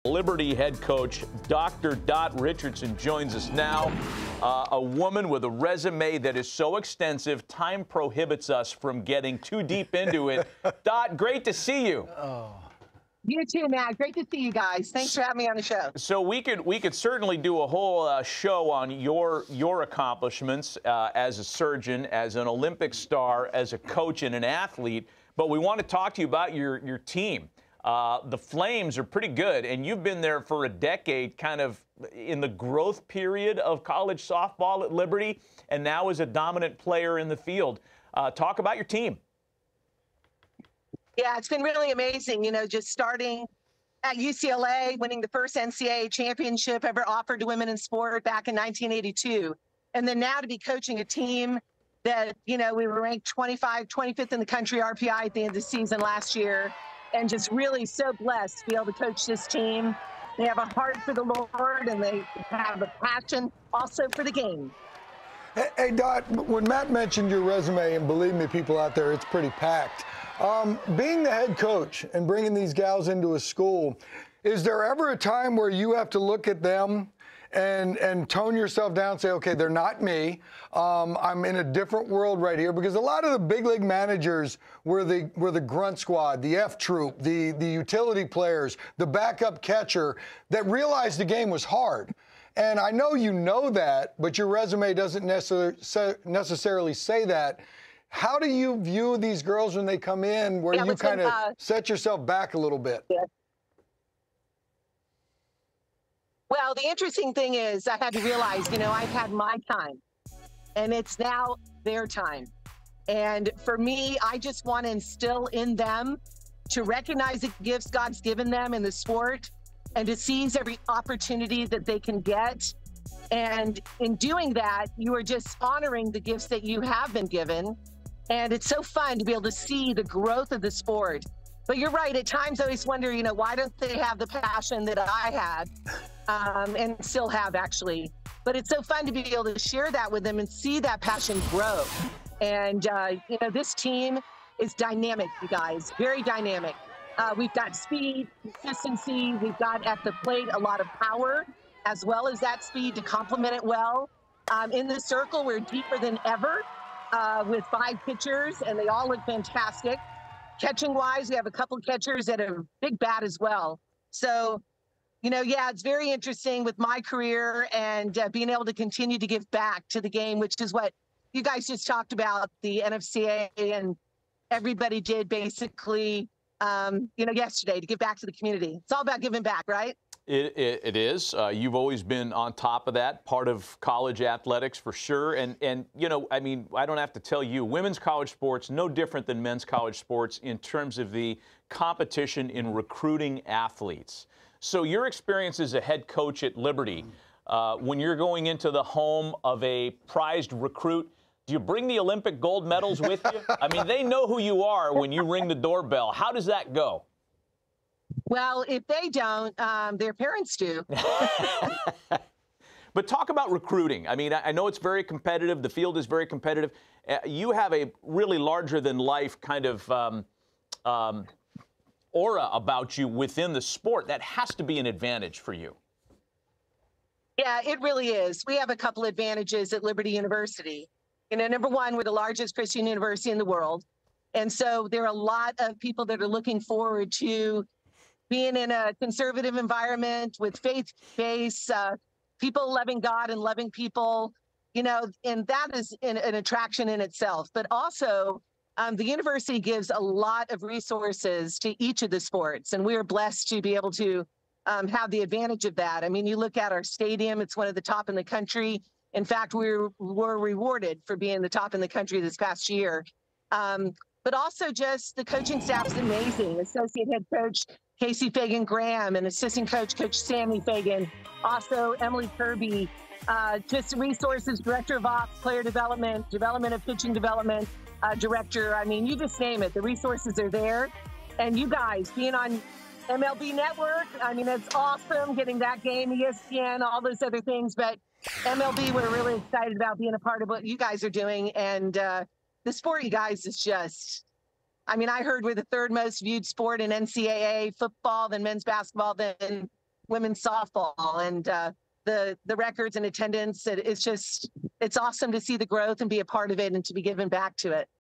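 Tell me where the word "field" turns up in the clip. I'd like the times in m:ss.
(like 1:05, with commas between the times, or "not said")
0:37, 3:35.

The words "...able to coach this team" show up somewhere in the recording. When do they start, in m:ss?
0:58.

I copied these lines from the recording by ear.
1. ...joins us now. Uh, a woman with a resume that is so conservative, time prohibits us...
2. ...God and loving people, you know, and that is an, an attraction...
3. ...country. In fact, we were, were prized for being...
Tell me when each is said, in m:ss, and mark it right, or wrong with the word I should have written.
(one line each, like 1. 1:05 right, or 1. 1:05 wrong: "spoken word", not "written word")
1. 0:02 wrong: "extensive", not "conservative"
2. 4:03 right
3. 4:18 wrong: "rewarded", not "prized".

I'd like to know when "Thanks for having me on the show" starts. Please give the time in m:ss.
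0:14.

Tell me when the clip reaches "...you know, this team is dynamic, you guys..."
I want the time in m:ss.
2:23.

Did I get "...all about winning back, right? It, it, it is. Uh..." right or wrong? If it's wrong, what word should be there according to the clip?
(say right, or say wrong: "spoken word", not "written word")
wrong: "giving", not "winning".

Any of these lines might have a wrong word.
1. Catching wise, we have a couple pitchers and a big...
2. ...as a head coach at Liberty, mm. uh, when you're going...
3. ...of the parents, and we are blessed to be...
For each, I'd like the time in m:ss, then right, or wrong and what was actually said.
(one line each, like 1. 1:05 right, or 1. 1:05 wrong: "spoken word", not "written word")
1. 2:40 wrong: "catchers", not "pitchers"
2. 3:15 right
3. 4:12 wrong: "sports", not "parents".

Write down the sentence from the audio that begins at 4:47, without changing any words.
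But MLB, we're really excited about being a part of what you guys are doing.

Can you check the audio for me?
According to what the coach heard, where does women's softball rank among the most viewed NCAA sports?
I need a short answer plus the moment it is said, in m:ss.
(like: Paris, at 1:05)
third, at 4:55.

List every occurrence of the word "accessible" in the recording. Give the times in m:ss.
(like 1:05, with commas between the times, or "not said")
not said.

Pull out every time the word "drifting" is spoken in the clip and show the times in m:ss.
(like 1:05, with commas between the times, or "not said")
not said.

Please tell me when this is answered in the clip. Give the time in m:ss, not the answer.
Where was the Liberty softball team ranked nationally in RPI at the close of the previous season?
0:53.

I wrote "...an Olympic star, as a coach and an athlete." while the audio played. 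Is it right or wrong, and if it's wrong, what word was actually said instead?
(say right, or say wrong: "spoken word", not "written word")
right.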